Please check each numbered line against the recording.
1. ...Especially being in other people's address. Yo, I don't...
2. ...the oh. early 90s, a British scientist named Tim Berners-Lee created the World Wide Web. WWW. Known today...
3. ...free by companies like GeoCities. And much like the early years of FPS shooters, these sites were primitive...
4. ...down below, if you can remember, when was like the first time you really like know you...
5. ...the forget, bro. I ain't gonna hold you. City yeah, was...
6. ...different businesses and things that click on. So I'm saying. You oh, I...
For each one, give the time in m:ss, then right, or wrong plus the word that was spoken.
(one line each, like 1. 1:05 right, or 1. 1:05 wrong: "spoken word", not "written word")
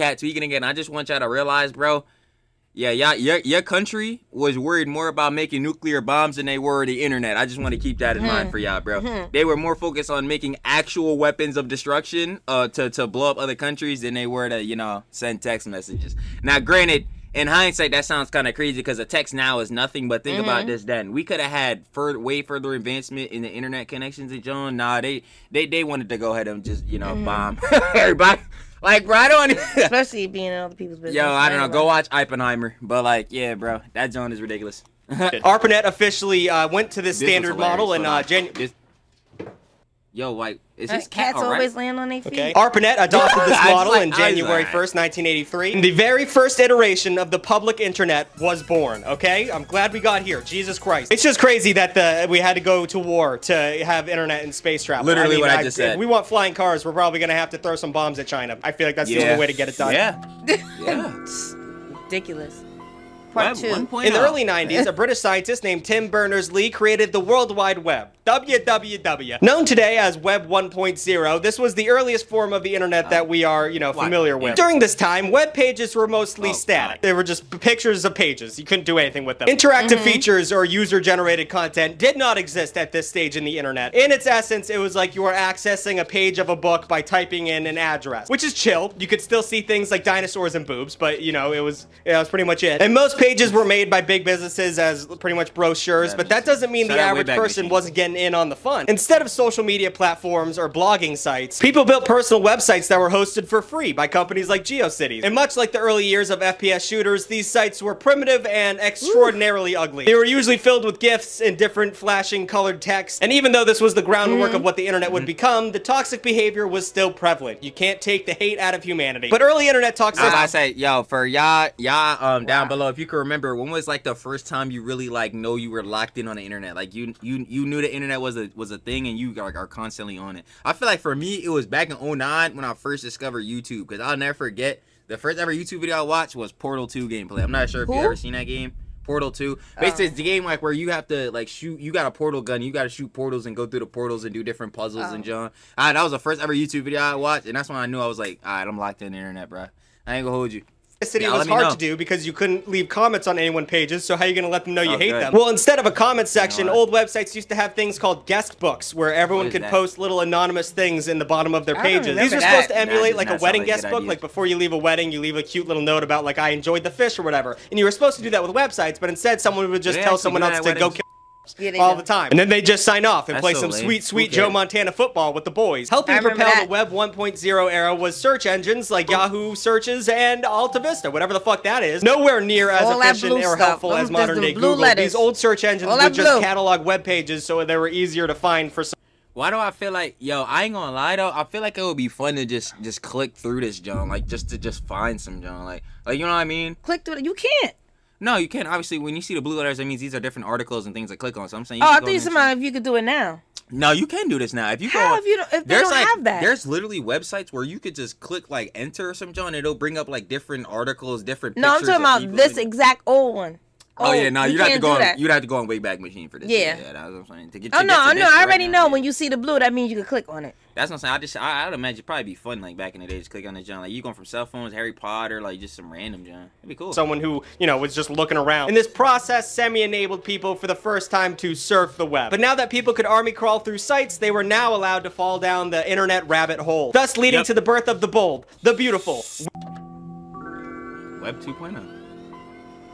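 1. 0:29 wrong: "business", not "address"
2. 1:04 right
3. 1:43 right
4. 2:02 right
5. 2:29 wrong: "internet", not "forget"
6. 3:20 wrong: "articles", not "businesses".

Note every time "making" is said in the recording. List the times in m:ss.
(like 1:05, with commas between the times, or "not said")
0:05, 0:10.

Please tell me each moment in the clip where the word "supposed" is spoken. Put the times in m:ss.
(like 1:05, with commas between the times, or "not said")
2:42, 2:47.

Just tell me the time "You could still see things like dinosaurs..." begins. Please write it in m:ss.
1:28.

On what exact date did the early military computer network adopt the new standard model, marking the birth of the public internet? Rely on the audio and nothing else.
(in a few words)
January 1st, 1983.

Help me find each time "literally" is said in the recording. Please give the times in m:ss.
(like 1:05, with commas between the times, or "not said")
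0:55, 3:26.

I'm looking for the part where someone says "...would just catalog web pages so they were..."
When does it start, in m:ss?
3:05.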